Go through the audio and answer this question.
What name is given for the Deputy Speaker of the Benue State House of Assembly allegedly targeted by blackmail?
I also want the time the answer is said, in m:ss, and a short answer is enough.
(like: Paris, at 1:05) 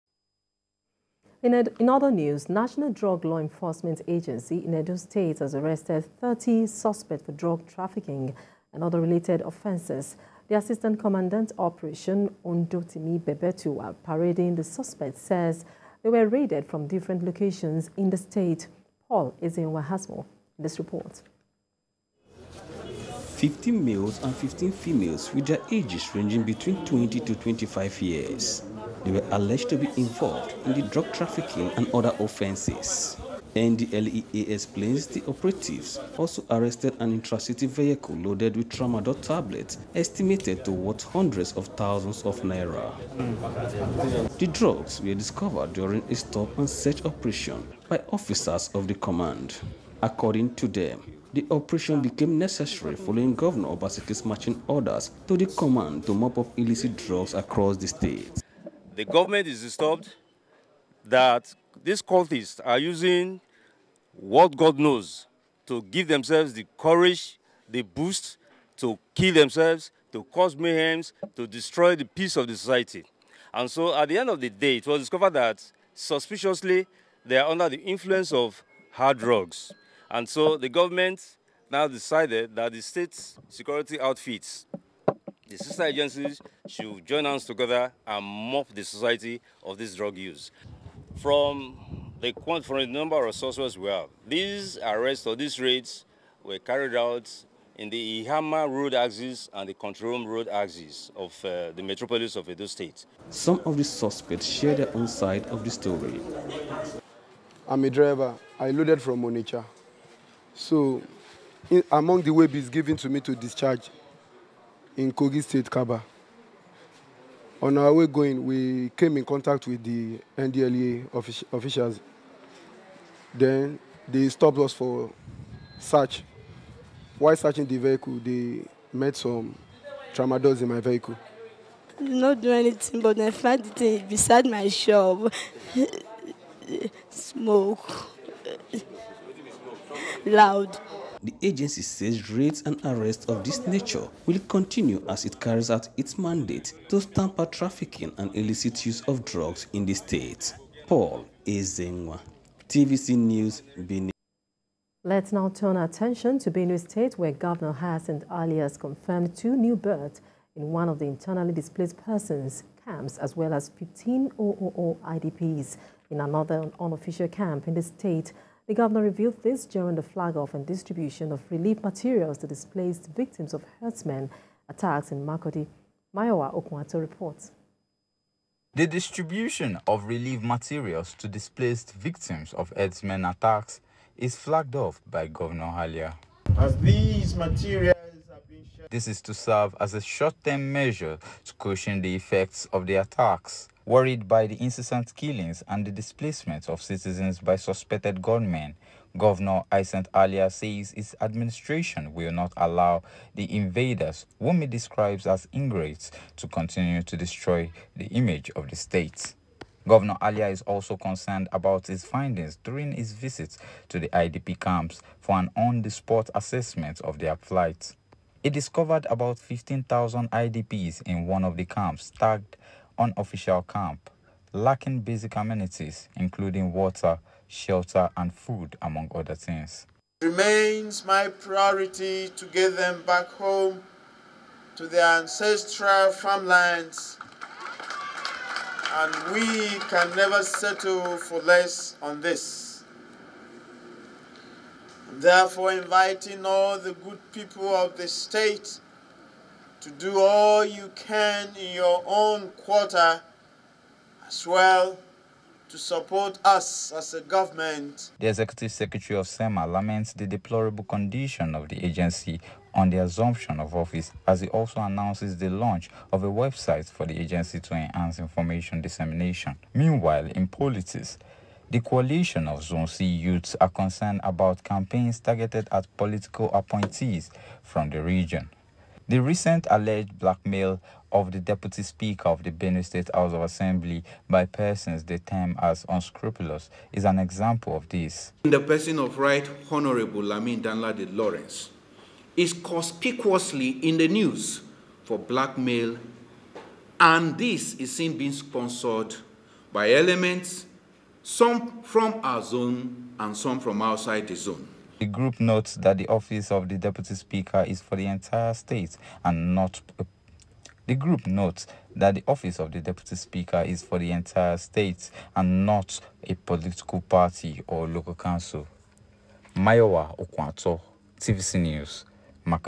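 Lamin Danladi Lawrence, at 4:50.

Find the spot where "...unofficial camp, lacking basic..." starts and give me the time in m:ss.
3:42.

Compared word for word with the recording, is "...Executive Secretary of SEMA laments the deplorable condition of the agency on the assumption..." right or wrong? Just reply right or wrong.
right.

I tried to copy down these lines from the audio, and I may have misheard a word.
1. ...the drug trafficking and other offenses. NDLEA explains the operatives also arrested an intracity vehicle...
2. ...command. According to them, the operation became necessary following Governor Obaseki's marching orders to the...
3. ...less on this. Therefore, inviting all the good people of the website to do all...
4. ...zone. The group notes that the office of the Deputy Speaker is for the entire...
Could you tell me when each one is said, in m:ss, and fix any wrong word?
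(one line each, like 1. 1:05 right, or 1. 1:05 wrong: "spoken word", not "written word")
1. 0:30 right
2. 0:48 right
3. 4:01 wrong: "state", not "website"
4. 5:04 right.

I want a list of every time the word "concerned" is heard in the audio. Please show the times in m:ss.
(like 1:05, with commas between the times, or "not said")
3:30, 4:33.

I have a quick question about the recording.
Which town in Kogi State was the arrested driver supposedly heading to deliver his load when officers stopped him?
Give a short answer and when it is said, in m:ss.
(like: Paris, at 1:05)
Kabba, at 1:55.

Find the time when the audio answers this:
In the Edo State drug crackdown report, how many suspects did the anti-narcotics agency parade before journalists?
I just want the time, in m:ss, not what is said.
0:06.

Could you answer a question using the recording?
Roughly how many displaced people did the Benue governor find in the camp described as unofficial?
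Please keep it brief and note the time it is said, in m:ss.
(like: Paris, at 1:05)
15,000, at 3:39.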